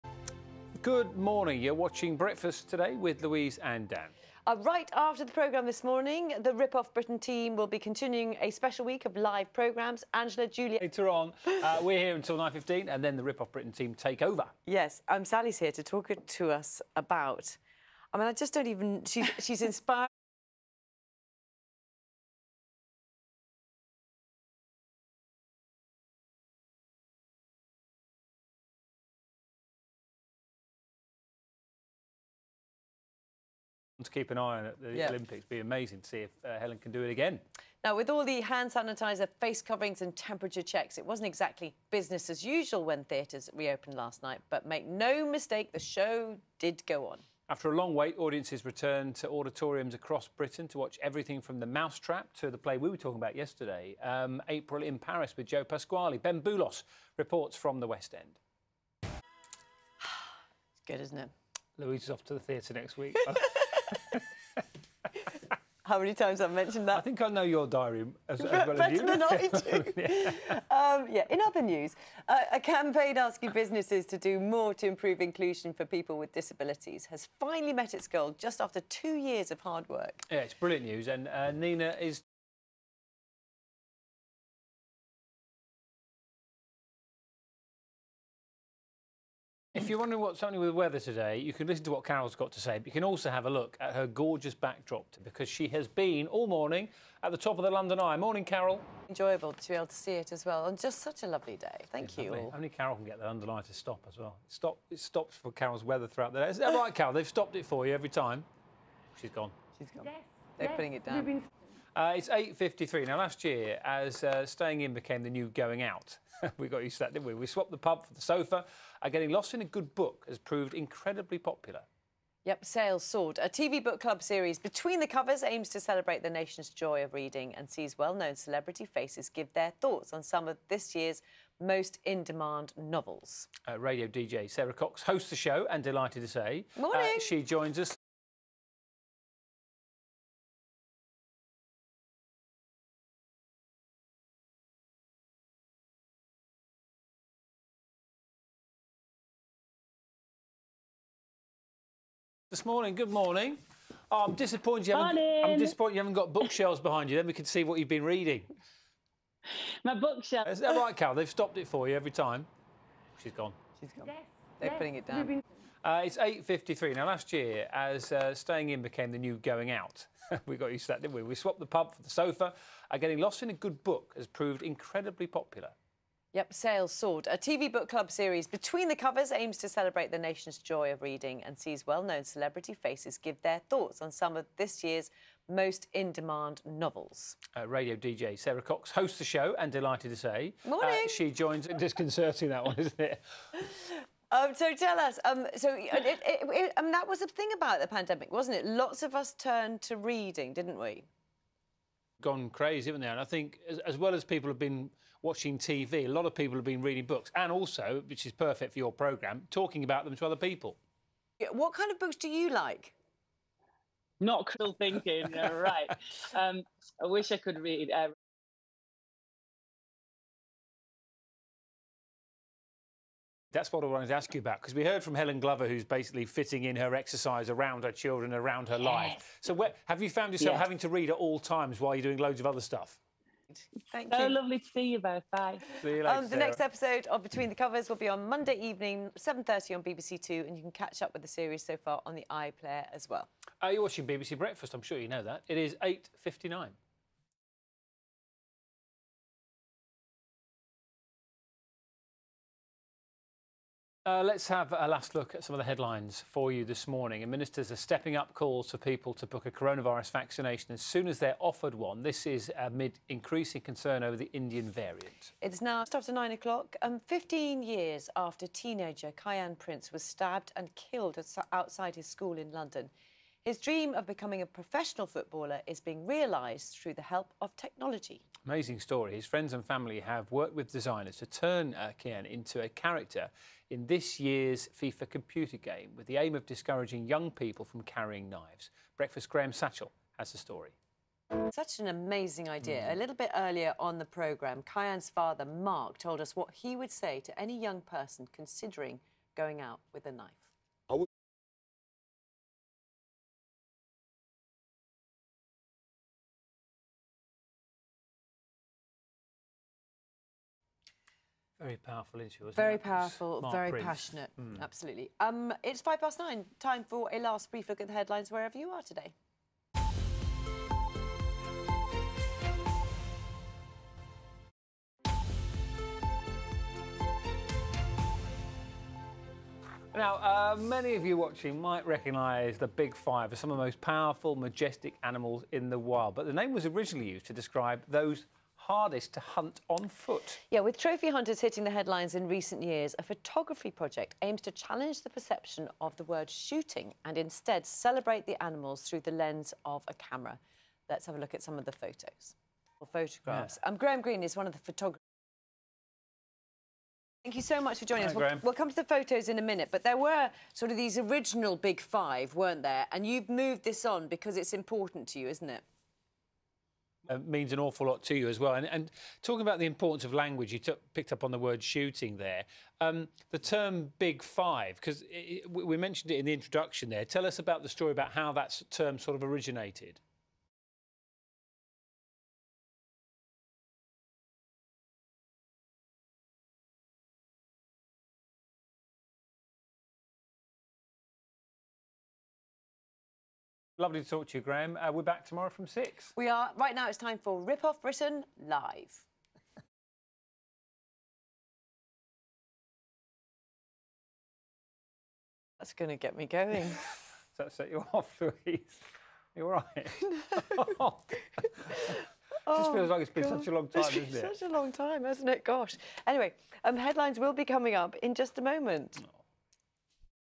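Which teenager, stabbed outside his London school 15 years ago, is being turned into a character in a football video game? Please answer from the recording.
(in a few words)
Kiyan Prince.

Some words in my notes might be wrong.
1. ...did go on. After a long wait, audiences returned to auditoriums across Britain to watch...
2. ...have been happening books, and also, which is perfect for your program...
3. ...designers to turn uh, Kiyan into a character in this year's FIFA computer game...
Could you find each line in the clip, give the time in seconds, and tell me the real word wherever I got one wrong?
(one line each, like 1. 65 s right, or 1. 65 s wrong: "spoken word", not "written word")
1. 46 s right
2. 206 s wrong: "reading", not "happening"
3. 280 s right.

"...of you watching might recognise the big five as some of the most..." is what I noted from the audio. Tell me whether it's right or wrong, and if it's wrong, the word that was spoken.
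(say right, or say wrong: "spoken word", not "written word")
right.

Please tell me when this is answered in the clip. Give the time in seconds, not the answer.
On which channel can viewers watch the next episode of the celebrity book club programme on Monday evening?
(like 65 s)
239 s.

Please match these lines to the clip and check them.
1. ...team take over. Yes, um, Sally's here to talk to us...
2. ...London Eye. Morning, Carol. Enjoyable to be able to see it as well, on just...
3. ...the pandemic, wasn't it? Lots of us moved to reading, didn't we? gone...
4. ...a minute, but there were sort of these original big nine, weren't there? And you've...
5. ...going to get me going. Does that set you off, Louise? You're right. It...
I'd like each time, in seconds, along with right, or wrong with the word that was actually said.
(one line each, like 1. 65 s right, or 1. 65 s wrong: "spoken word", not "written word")
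1. 13 s right
2. 97 s right
3. 197 s wrong: "turned", not "moved"
4. 359 s wrong: "five", not "nine"
5. 405 s right.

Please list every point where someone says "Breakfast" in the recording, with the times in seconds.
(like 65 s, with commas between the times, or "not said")
2 s, 244 s, 288 s.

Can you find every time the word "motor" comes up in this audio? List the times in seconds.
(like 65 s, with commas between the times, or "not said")
not said.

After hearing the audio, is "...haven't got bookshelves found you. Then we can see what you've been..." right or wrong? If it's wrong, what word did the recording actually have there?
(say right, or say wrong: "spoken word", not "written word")
wrong: "behind", not "found".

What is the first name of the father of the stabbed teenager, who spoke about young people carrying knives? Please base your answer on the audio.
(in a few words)
Mark.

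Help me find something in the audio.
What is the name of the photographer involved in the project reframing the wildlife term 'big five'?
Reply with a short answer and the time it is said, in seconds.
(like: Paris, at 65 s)
Graham Green, at 353 s.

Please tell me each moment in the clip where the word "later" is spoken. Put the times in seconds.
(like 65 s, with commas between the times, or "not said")
10 s, 236 s.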